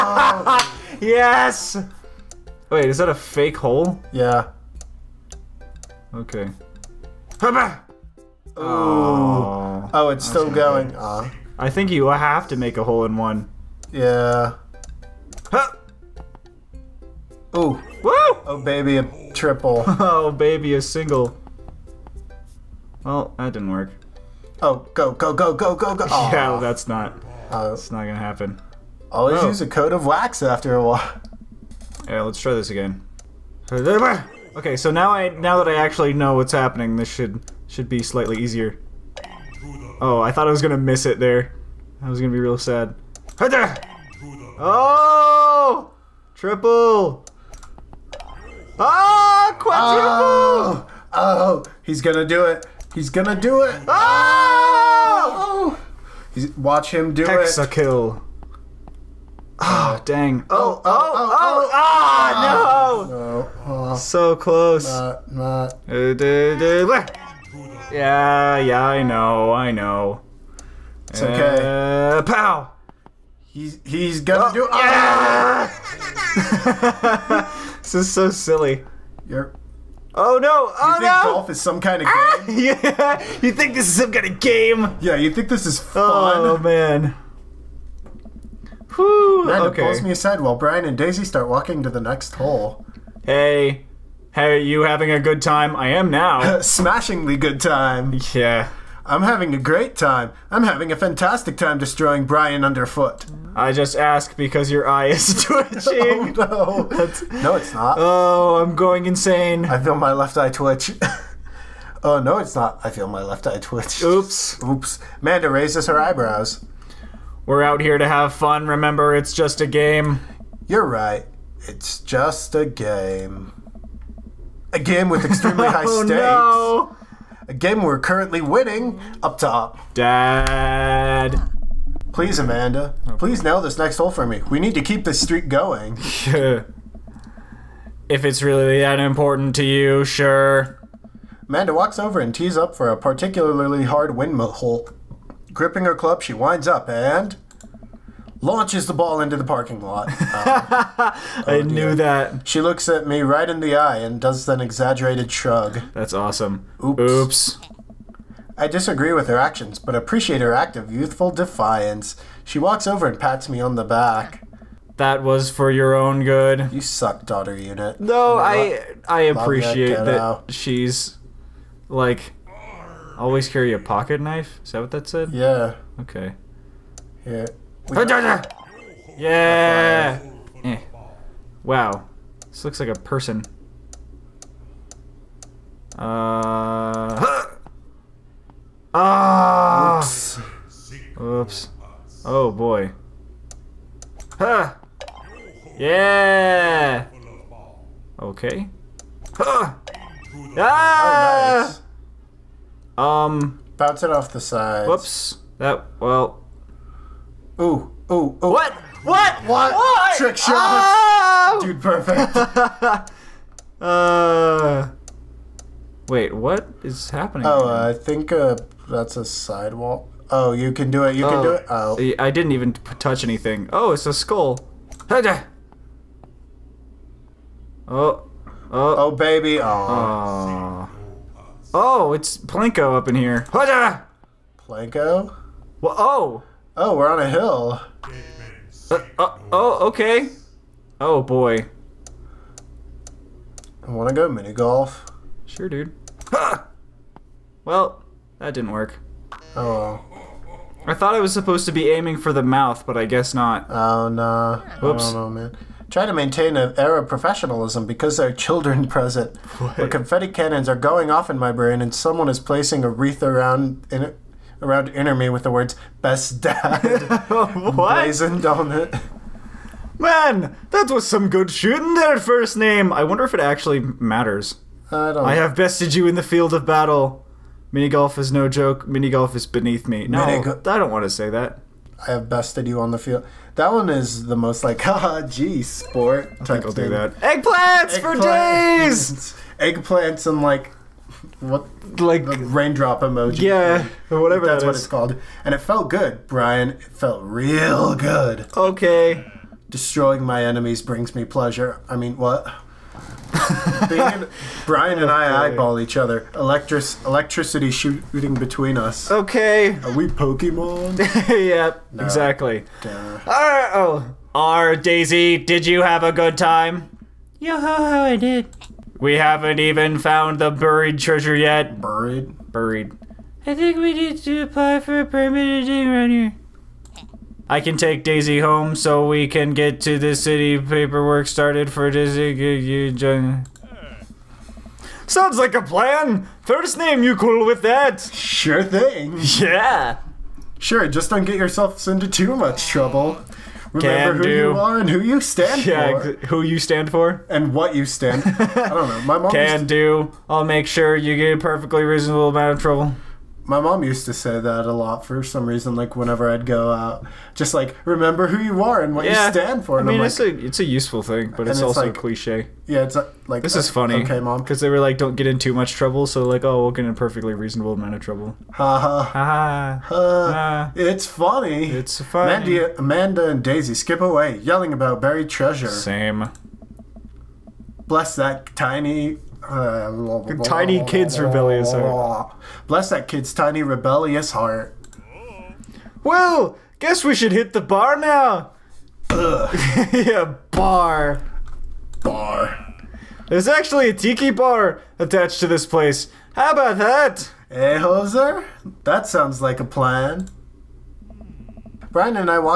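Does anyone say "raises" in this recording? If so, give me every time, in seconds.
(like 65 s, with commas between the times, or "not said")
115 s.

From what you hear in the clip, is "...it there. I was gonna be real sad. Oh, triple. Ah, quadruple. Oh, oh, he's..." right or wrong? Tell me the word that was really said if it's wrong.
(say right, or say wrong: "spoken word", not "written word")
right.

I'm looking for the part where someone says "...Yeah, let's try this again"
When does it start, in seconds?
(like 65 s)
32 s.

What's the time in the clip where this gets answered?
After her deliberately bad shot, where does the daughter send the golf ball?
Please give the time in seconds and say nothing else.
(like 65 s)
149 s.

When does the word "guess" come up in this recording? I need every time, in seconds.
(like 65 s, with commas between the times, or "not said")
253 s, 386 s.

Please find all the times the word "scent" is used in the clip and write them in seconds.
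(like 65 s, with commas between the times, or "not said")
not said.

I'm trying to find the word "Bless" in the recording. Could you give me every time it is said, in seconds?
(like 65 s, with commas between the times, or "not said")
377 s, 382 s.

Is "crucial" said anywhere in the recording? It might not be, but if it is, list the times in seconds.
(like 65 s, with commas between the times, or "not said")
not said.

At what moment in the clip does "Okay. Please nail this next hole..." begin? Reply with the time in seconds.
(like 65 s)
133 s.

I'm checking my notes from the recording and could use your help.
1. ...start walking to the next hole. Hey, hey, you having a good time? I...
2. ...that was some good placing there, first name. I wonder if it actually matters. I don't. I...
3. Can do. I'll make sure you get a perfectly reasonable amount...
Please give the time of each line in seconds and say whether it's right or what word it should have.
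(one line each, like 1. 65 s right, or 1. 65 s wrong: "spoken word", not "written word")
1. 91 s right
2. 270 s wrong: "shooting", not "placing"
3. 349 s right.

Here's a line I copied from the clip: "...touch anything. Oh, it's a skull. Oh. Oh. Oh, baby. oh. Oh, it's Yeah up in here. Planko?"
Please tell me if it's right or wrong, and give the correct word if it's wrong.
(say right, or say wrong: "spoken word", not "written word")
wrong: "Planko", not "Yeah".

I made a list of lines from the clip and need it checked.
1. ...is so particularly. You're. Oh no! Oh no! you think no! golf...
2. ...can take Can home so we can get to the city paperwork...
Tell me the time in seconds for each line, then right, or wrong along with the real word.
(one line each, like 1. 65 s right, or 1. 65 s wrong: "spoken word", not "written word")
1. 77 s wrong: "silly", not "particularly"
2. 327 s wrong: "Daisy", not "Can".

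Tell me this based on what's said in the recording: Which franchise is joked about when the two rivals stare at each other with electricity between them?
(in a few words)
Pokemon.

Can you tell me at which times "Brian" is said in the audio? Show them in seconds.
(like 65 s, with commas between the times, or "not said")
90 s, 102 s, 296 s, 304 s, 401 s.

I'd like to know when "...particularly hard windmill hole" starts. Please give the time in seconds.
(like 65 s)
142 s.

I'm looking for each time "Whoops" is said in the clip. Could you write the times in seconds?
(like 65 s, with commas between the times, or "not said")
204 s, 254 s.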